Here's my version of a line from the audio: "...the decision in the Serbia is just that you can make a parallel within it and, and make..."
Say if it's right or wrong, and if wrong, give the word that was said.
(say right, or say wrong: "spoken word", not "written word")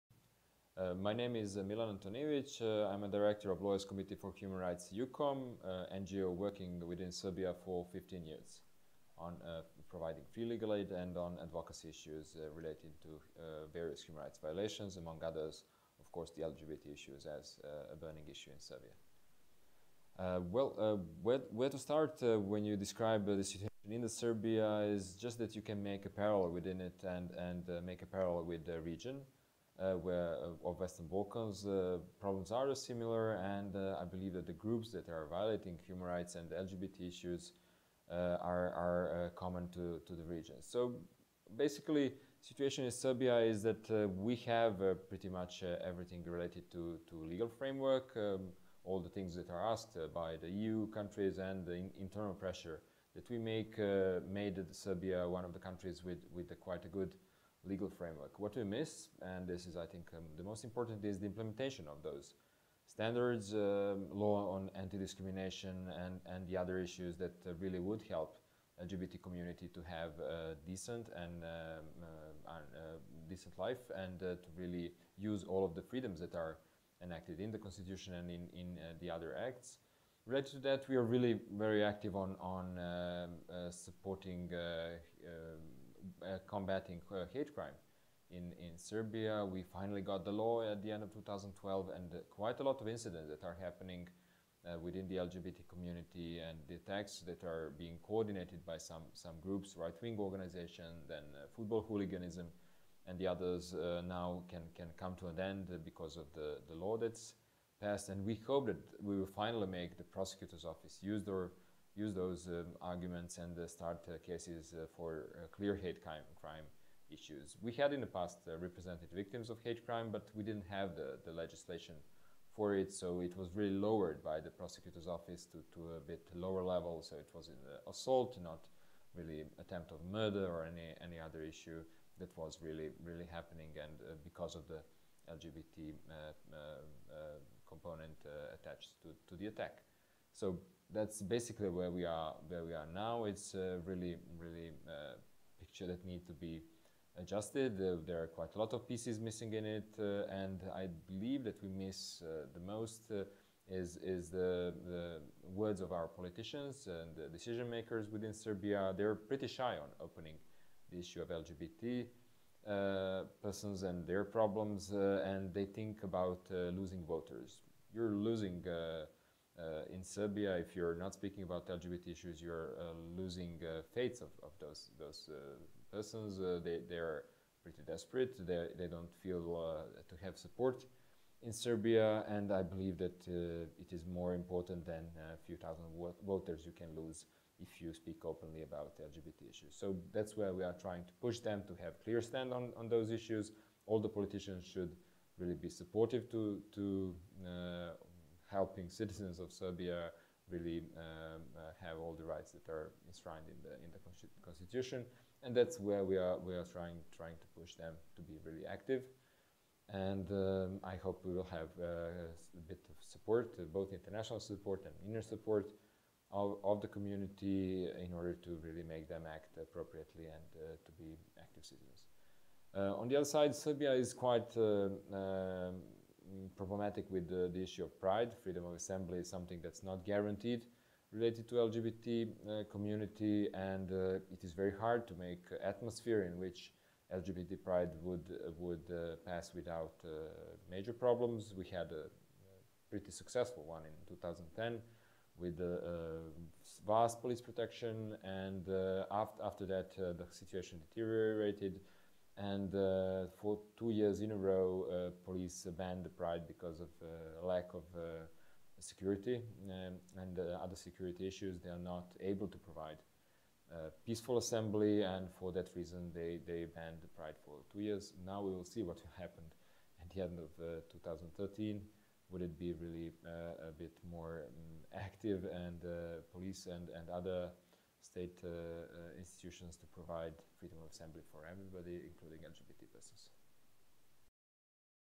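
wrong: "situation", not "decision".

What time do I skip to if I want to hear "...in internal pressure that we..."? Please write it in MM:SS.
00:51.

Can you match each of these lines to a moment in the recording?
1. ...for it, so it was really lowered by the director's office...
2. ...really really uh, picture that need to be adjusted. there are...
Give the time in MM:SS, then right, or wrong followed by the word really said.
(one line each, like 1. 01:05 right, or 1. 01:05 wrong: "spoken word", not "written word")
1. 02:02 wrong: "prosecutor", not "director"
2. 02:23 right.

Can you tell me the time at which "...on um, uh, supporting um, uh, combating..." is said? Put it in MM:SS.
01:22.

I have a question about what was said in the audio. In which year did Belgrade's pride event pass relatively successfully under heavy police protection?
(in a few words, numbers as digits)
2010.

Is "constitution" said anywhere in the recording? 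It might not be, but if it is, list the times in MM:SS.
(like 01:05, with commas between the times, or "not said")
01:17, 03:24.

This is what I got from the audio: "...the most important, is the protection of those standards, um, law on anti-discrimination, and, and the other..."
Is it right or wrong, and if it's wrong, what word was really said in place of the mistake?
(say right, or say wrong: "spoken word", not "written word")
wrong: "implementation", not "protection".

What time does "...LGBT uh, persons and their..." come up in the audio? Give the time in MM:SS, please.
02:41.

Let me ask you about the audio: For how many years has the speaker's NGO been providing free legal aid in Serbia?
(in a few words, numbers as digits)
15 years.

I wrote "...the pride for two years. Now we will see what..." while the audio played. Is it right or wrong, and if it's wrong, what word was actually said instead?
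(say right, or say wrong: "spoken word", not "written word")
right.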